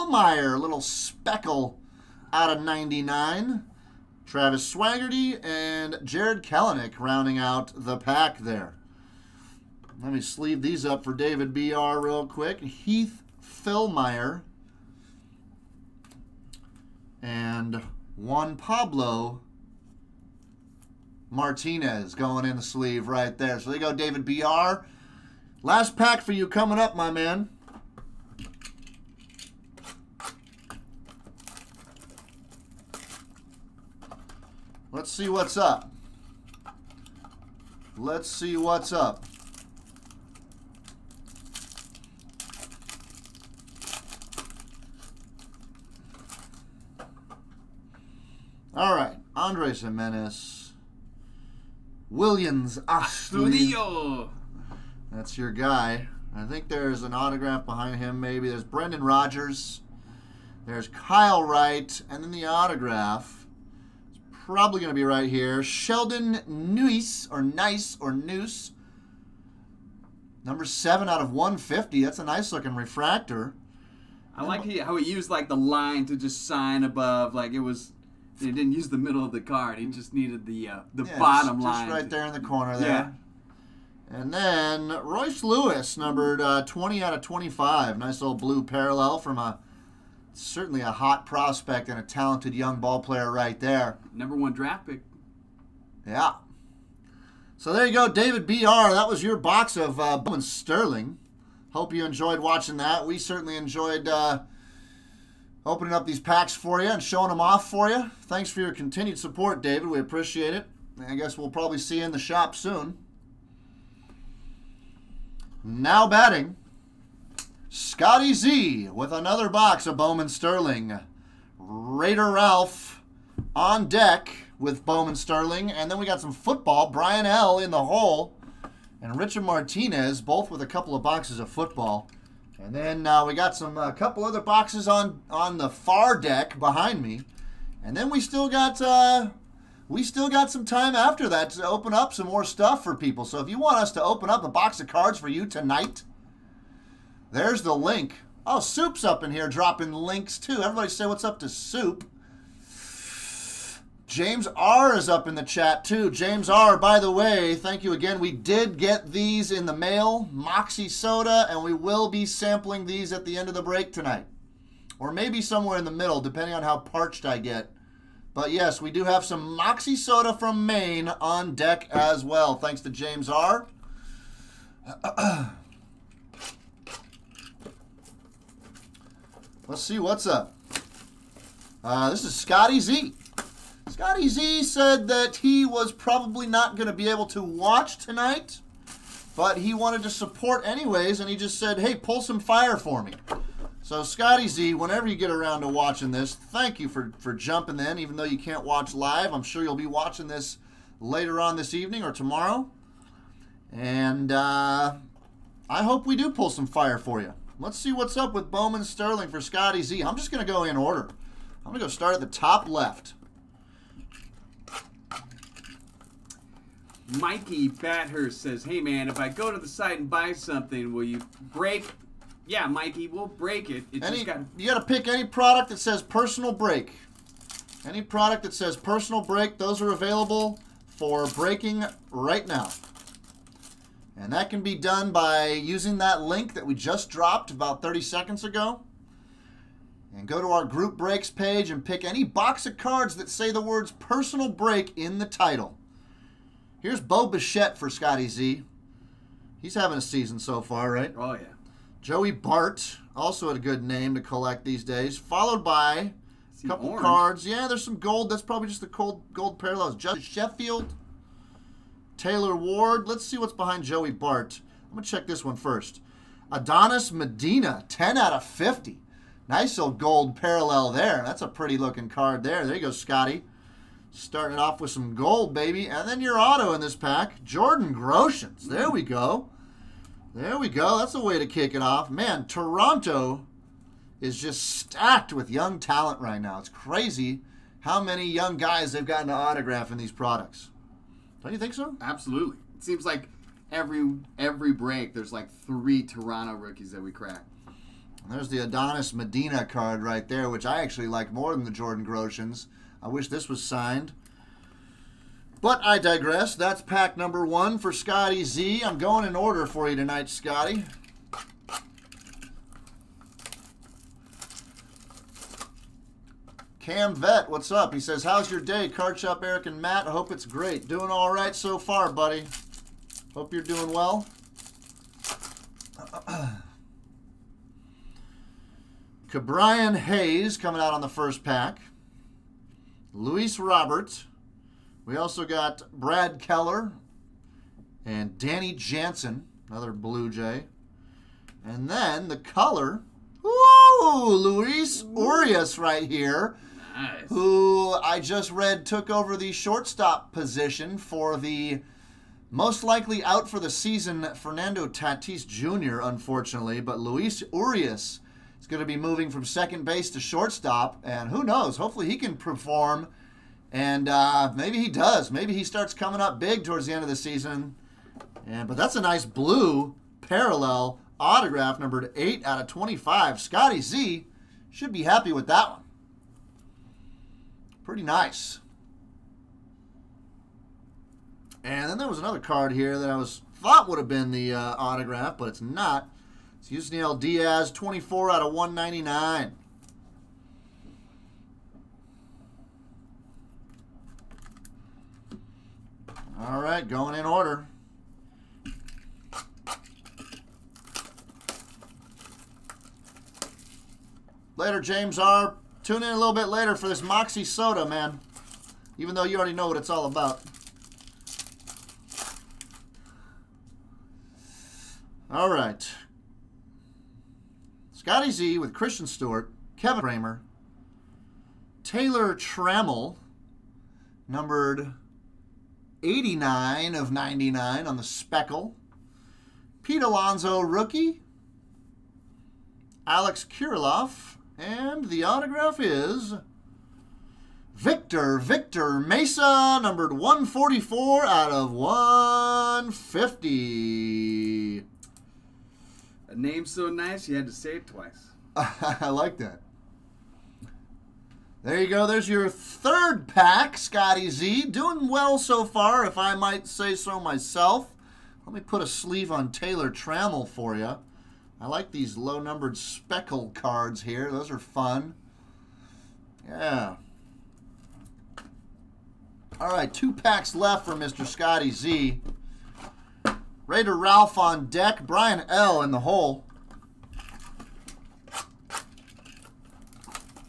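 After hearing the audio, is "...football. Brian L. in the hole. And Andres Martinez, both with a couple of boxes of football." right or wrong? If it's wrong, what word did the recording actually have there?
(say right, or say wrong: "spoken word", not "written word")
wrong: "Richard", not "Andres".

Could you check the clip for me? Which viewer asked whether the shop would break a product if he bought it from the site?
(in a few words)
Mikey Bathurst.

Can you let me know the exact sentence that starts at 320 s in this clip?
Doing all right so far, buddy.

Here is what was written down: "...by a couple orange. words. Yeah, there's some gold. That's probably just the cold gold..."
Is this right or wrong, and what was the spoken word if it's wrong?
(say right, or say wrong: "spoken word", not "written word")
wrong: "cards", not "words".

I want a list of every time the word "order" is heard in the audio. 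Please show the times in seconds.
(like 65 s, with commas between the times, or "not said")
210 s, 309 s, 397 s.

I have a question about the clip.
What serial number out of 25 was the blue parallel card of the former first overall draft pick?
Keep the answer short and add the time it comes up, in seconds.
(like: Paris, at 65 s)
20, at 86 s.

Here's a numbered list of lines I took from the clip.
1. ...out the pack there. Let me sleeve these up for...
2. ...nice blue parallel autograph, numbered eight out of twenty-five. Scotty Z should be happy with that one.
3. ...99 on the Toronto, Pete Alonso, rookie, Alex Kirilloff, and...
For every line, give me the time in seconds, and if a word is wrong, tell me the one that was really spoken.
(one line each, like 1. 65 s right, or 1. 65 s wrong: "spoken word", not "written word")
1. 7 s right
2. 369 s right
3. 427 s wrong: "Speckle", not "Toronto".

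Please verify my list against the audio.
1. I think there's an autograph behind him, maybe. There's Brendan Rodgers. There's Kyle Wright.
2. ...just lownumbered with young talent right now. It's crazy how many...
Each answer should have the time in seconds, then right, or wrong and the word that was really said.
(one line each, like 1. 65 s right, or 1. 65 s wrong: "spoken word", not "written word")
1. 56 s right
2. 284 s wrong: "stacked", not "lownumbered".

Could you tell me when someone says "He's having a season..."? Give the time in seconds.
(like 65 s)
249 s.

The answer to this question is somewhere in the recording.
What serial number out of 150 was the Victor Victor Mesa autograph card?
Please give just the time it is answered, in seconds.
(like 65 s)
440 s.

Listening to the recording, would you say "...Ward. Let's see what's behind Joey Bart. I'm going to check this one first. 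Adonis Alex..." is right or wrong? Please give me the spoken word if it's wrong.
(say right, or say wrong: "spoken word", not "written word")
wrong: "Medina", not "Alex".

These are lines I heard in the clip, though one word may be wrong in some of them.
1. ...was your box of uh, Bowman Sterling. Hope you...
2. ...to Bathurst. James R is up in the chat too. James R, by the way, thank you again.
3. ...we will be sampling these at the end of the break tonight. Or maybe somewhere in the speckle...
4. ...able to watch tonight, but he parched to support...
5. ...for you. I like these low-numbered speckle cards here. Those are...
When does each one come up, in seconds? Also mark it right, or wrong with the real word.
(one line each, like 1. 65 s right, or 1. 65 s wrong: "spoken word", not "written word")
1. 99 s right
2. 151 s wrong: "Soup", not "Bathurst"
3. 161 s wrong: "middle", not "speckle"
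4. 187 s wrong: "wanted", not "parched"
5. 460 s right.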